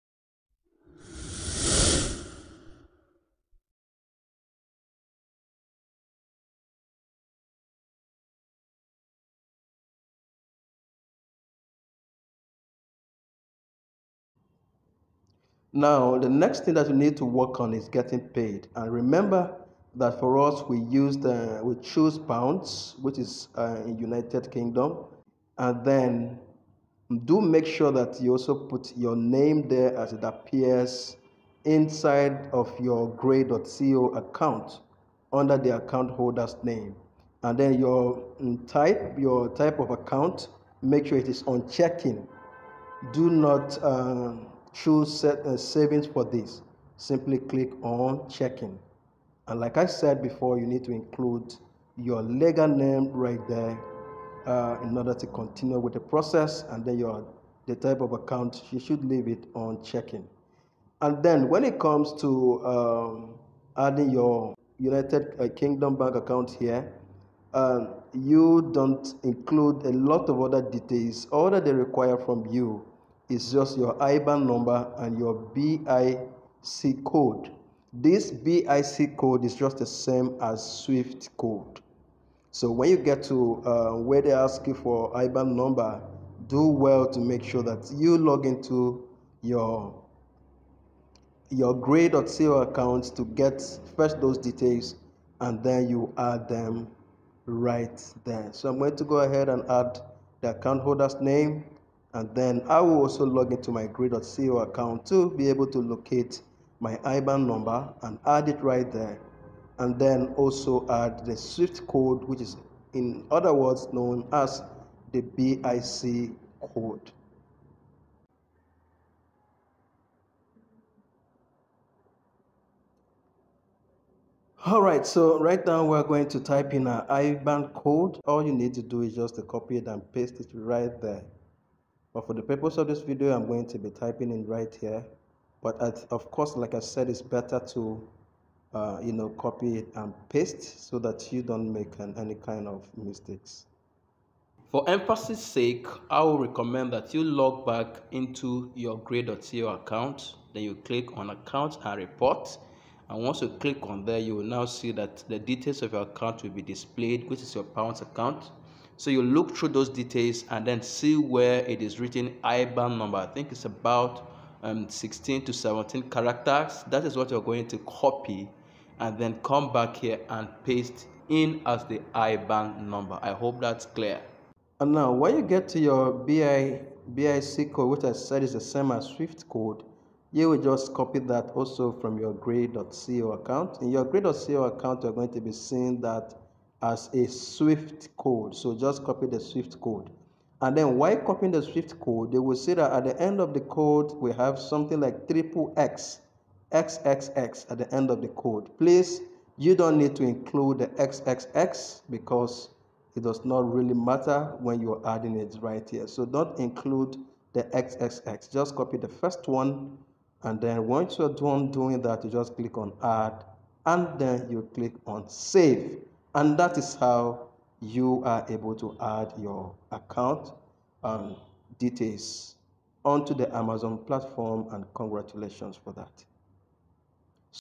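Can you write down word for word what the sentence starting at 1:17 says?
This BIC code is just the same as SWIFT code.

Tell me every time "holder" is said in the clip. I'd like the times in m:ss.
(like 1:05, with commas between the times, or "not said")
0:36, 1:40.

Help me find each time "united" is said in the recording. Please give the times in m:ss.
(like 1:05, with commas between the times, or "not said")
0:23, 1:04.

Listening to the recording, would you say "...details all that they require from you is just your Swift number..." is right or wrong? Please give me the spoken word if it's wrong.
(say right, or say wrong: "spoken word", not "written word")
wrong: "IBAN", not "Swift".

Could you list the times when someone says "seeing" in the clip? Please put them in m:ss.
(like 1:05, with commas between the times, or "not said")
3:05.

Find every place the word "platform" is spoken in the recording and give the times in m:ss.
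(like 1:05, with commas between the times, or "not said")
3:43.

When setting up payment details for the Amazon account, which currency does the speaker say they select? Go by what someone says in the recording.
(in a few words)
Pounds.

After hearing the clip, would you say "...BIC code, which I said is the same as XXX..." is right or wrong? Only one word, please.
wrong.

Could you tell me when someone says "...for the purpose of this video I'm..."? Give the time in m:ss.
2:12.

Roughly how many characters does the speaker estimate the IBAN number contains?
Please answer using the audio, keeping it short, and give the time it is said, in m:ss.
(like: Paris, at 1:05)
16 to 17, at 2:44.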